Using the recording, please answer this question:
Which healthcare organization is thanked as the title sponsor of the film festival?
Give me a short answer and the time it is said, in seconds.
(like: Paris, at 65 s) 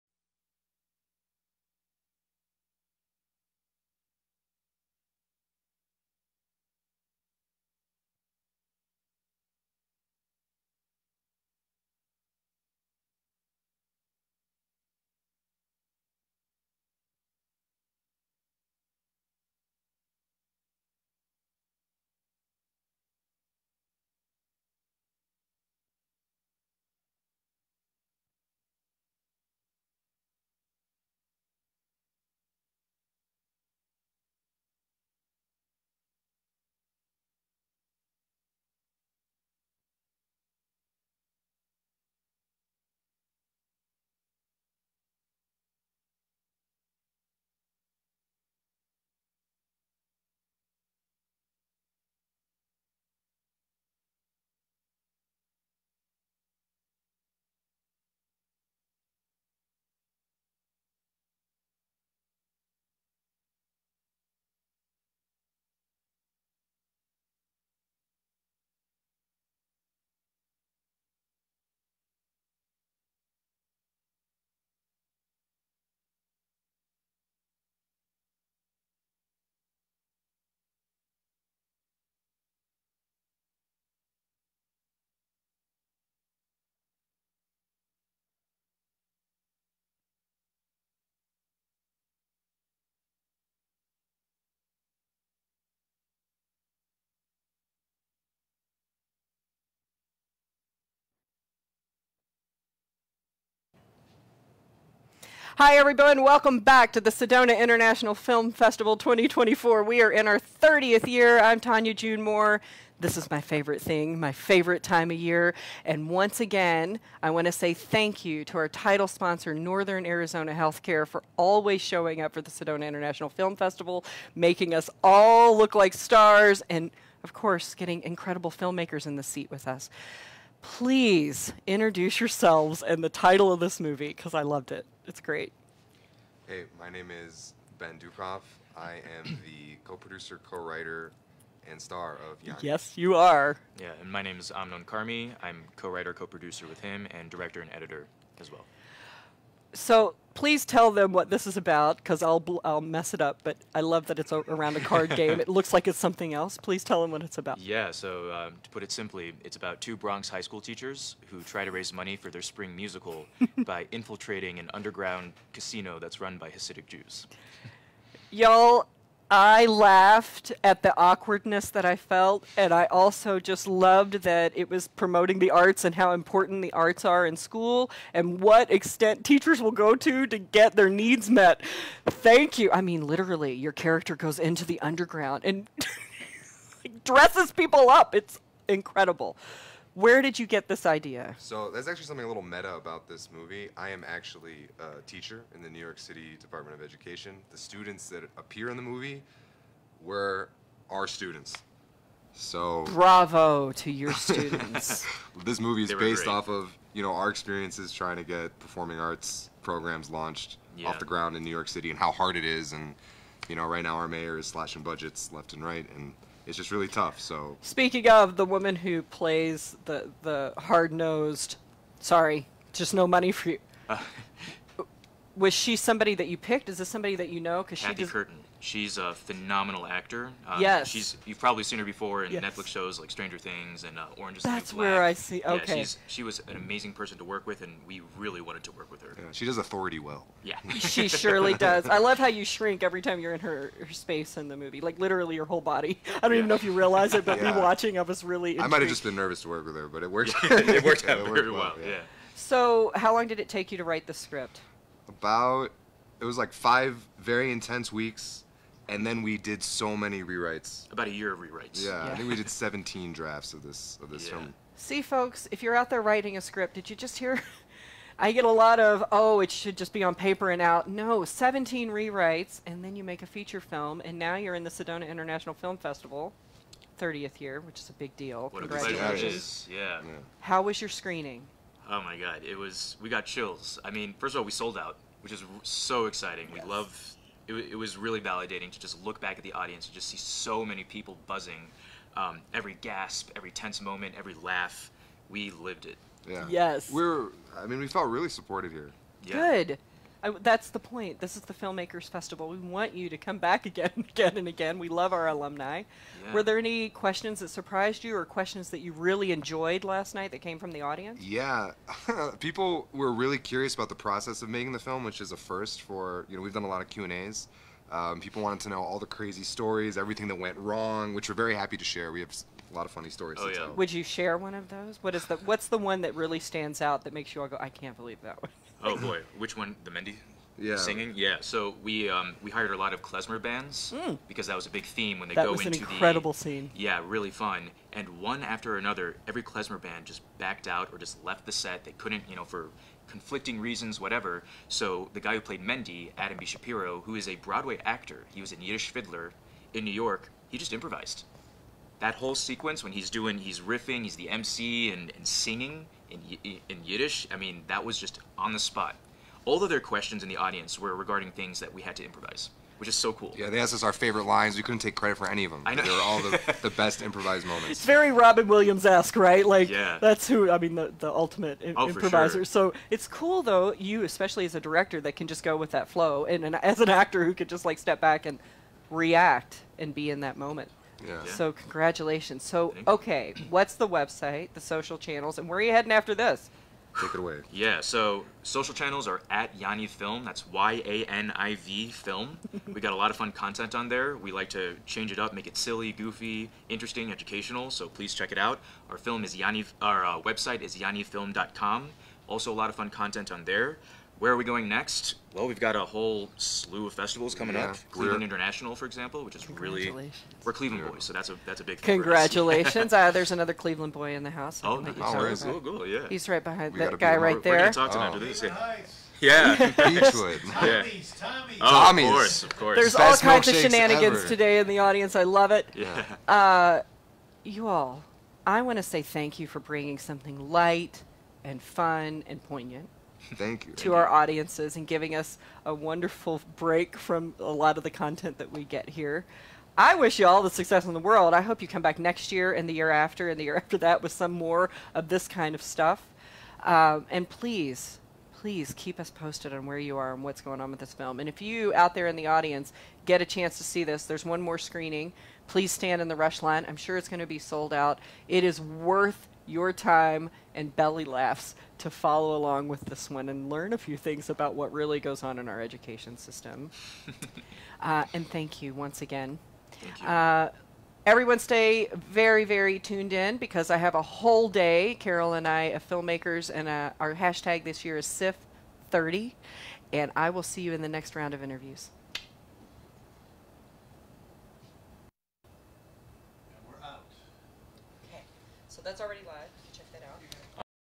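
Northern Arizona Healthcare, at 119 s.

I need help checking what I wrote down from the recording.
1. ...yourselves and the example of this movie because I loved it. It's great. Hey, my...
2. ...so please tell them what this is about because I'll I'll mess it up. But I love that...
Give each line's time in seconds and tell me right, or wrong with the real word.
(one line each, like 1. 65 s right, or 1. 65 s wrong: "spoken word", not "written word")
1. 132 s wrong: "title", not "example"
2. 149 s right.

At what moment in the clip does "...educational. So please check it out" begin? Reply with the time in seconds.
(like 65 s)
397 s.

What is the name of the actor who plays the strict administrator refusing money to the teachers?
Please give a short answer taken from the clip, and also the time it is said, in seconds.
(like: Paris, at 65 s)
Cathy Curtin, at 227 s.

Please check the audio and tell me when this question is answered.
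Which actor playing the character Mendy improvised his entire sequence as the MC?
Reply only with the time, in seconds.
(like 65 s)
346 s.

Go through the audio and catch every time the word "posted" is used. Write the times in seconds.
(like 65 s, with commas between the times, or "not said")
449 s.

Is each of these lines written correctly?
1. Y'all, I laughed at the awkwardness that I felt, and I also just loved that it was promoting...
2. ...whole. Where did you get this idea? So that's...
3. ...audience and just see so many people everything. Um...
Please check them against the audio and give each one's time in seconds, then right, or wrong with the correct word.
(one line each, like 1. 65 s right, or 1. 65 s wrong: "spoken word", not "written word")
1. 168 s right
2. 188 s wrong: "incredible", not "whole"
3. 289 s wrong: "buzzing", not "everything".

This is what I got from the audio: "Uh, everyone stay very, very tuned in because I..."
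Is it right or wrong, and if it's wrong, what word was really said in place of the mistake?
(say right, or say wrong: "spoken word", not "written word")
right.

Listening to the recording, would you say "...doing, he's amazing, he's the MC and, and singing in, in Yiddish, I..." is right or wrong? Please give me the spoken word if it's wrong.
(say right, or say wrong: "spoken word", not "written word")
wrong: "riffing", not "amazing".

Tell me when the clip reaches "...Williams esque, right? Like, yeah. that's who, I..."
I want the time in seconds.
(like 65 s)
368 s.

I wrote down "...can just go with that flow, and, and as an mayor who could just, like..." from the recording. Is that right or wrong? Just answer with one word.
wrong.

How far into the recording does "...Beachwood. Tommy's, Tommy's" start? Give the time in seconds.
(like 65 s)
419 s.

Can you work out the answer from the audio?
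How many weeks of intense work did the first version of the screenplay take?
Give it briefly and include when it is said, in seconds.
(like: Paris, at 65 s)
5, at 256 s.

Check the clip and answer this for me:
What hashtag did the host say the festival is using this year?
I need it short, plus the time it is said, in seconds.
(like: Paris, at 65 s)
SIF30, at 478 s.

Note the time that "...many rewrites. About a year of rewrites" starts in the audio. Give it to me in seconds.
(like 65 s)
259 s.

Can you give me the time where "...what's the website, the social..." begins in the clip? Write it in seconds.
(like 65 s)
383 s.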